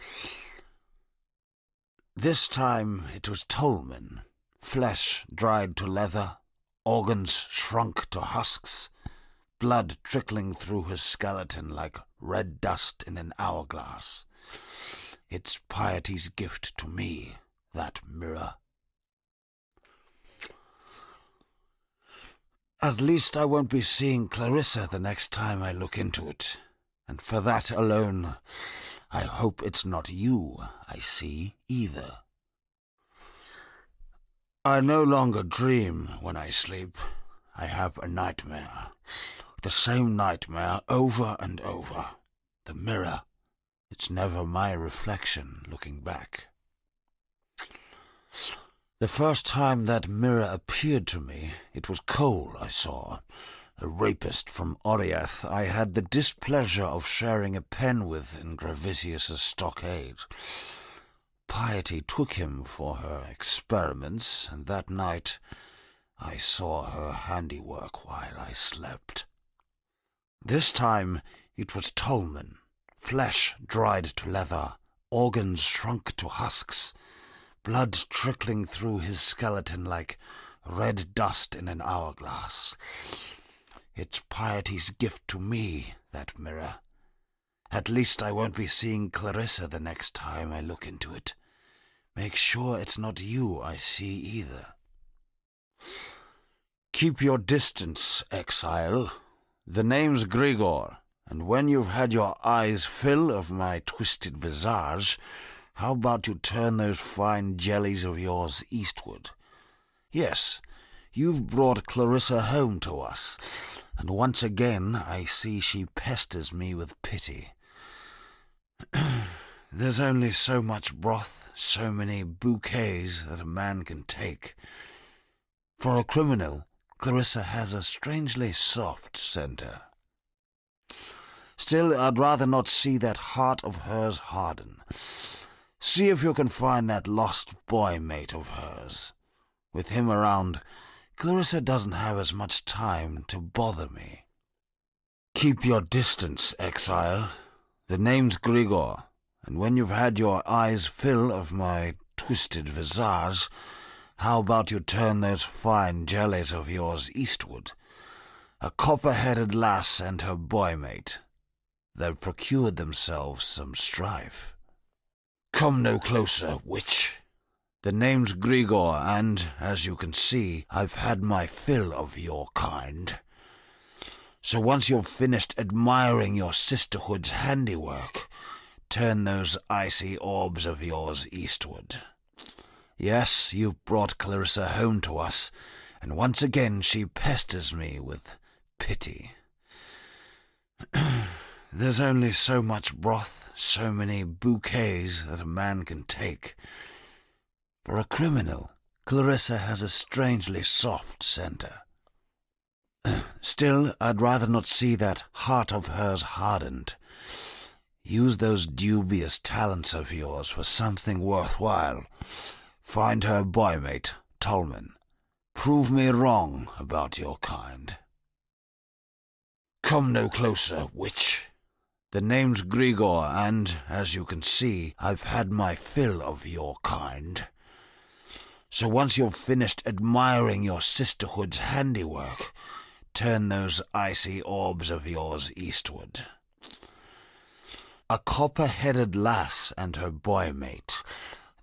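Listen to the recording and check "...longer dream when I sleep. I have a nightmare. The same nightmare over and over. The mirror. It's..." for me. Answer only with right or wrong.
right.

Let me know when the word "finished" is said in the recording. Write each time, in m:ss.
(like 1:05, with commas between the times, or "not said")
2:55, 3:49.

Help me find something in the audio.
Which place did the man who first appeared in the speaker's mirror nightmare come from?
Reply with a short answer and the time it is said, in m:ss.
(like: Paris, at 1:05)
Oriath, at 0:54.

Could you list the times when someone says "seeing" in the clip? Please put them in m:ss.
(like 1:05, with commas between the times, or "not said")
0:23, 1:28.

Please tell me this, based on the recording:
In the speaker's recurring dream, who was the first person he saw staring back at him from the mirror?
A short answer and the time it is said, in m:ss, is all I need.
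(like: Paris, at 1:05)
Cole, at 0:52.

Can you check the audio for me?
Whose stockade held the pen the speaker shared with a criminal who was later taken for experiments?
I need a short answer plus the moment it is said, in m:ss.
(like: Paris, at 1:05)
Gravicius, at 0:58.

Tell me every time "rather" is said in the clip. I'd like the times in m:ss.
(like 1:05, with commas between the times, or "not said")
2:12, 3:24.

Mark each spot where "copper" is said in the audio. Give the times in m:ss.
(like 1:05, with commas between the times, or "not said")
2:38, 3:58.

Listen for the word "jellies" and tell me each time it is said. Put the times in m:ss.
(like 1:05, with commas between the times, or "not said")
1:47, 2:36.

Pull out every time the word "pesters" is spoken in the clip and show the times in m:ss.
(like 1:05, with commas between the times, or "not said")
1:55, 3:07.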